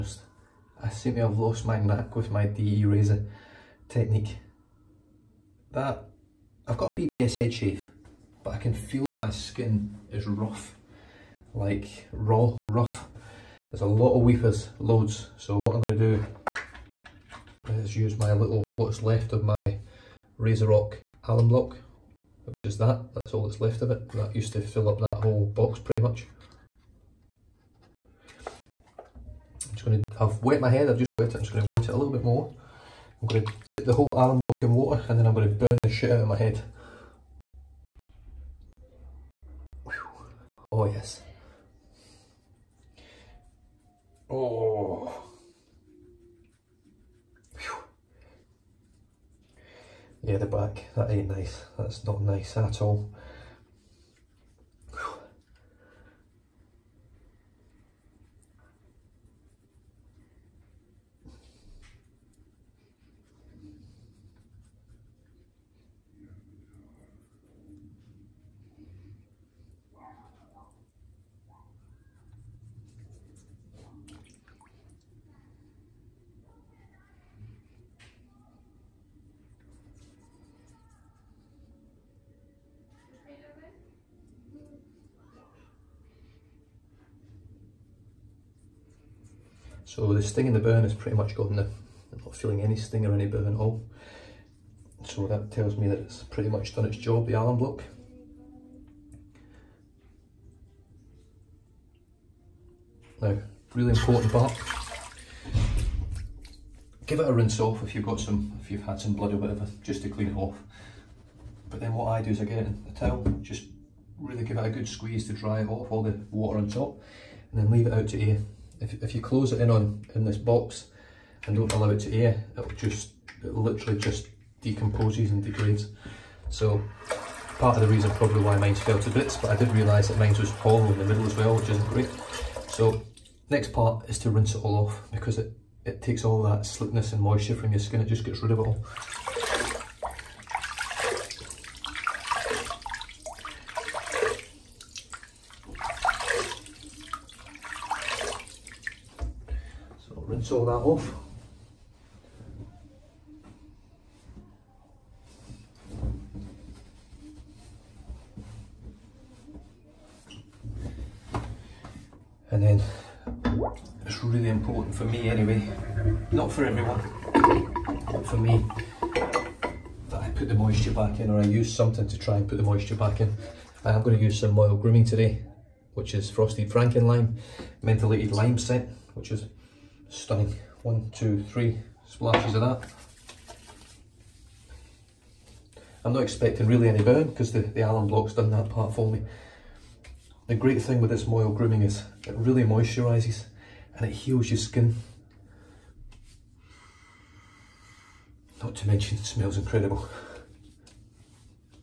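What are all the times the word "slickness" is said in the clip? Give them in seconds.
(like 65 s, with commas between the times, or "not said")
136 s.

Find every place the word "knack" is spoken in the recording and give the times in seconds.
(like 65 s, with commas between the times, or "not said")
1 s.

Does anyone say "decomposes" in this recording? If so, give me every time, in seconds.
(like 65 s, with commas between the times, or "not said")
124 s.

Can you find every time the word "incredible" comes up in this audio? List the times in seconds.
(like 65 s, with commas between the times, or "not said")
199 s.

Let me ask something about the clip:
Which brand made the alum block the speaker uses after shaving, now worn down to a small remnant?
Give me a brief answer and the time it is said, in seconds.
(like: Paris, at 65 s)
RazoRock, at 20 s.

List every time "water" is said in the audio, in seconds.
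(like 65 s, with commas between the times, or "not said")
34 s, 116 s.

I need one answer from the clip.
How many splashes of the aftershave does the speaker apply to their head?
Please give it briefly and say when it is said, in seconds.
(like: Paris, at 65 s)
3, at 181 s.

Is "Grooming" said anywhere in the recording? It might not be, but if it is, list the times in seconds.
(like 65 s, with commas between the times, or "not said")
174 s, 191 s.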